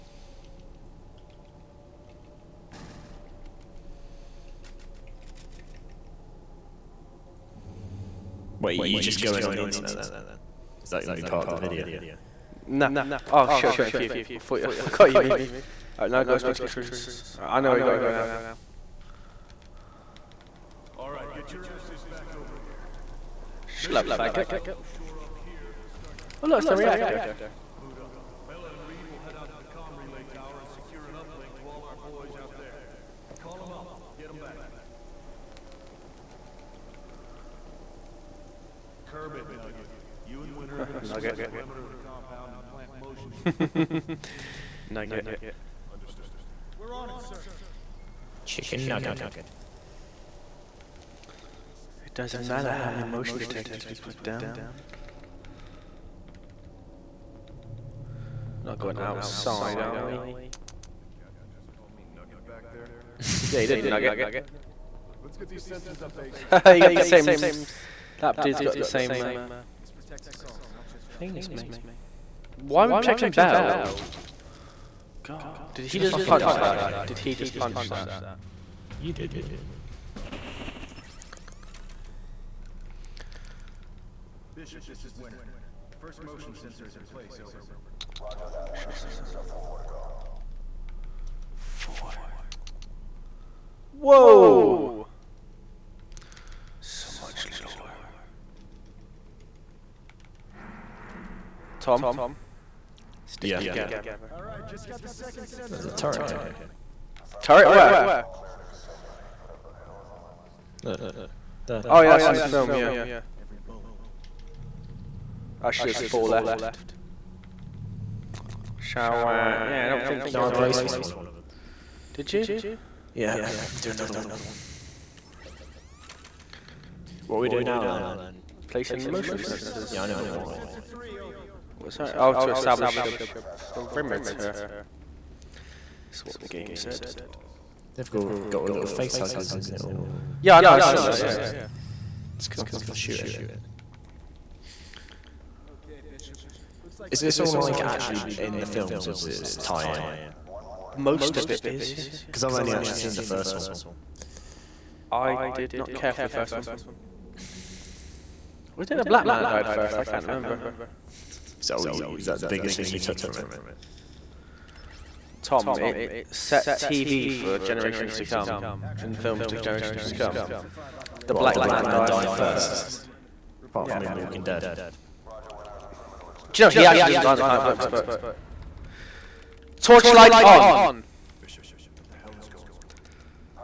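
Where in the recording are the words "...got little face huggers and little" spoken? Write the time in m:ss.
2:18.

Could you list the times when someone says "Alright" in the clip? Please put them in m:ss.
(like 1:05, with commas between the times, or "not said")
0:15, 0:20.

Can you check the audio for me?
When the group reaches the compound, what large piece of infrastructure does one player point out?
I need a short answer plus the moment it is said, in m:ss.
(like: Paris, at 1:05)
the reactor, at 0:26.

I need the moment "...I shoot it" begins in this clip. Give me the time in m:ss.
2:22.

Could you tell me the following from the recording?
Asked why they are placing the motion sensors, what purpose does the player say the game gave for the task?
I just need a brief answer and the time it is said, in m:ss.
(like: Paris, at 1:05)
To establish a perimeter, at 2:12.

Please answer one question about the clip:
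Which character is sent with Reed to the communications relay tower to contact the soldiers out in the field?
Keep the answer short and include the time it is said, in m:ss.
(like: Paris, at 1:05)
Bella, at 0:28.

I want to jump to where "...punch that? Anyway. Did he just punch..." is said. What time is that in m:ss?
1:16.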